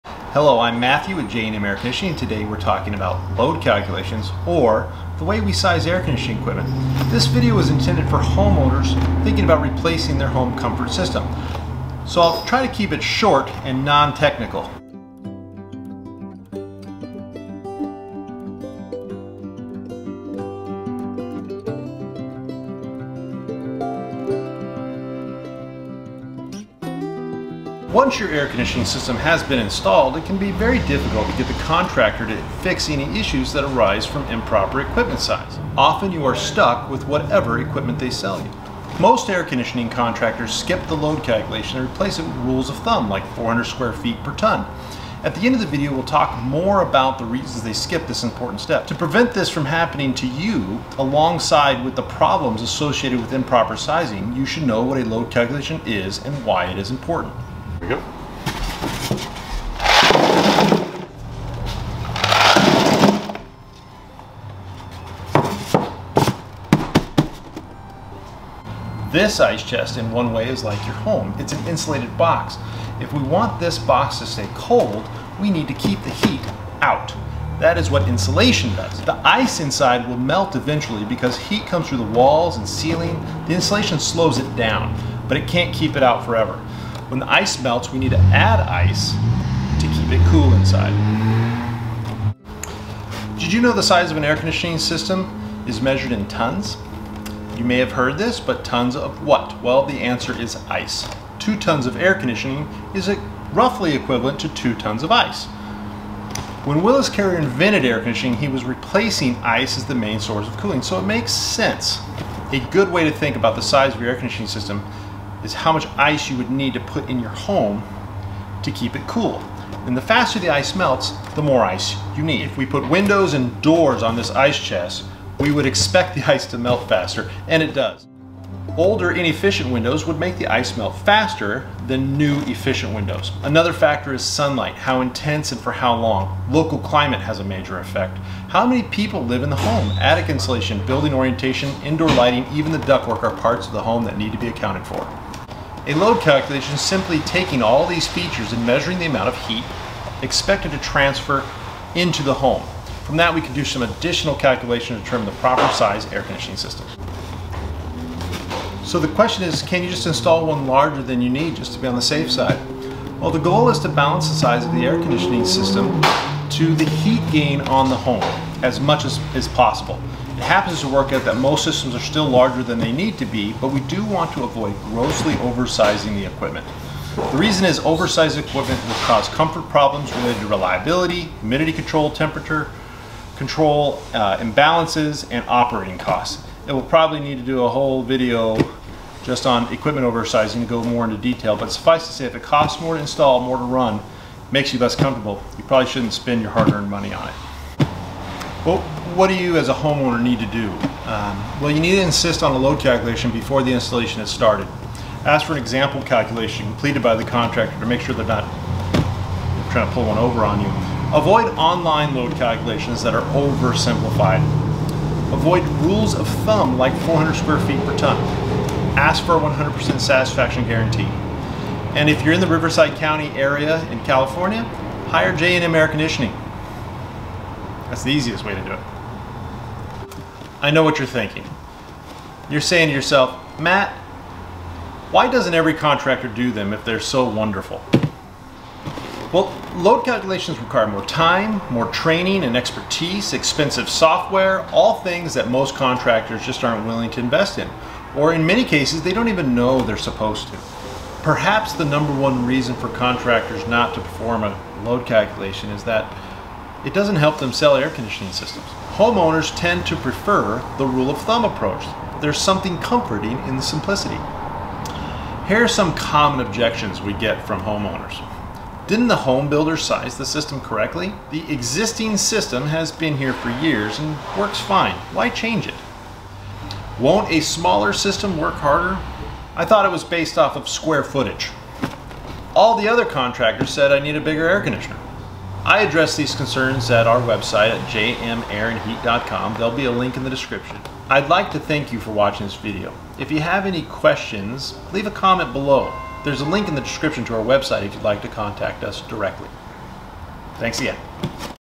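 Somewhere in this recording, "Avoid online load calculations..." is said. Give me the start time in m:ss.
3:31.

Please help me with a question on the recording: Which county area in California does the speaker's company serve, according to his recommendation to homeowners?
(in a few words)
Riverside County.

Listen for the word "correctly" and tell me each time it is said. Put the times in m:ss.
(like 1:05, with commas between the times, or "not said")
4:30.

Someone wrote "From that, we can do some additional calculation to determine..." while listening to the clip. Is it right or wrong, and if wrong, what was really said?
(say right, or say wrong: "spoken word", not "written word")
right.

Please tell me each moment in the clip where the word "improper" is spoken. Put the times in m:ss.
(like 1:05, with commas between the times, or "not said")
0:34, 0:53.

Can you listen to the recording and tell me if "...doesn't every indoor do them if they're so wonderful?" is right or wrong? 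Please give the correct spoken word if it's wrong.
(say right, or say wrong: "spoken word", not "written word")
wrong: "contractor", not "indoor".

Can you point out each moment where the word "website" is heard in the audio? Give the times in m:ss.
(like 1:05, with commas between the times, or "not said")
4:47, 4:57.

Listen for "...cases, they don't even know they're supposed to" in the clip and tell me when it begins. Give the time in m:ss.
4:08.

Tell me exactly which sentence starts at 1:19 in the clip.
The ice inside will melt eventually because heat comes through the walls and ceiling.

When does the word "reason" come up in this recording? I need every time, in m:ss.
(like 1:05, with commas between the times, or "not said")
0:47, 2:57, 4:12.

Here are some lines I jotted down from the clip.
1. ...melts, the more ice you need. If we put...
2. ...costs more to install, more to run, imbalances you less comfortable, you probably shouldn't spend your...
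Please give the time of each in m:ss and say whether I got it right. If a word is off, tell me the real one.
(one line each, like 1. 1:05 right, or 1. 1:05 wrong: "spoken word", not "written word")
1. 2:00 right
2. 3:12 wrong: "makes", not "imbalances".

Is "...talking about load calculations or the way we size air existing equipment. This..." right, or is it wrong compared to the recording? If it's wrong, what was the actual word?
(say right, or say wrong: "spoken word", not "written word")
wrong: "conditioning", not "existing".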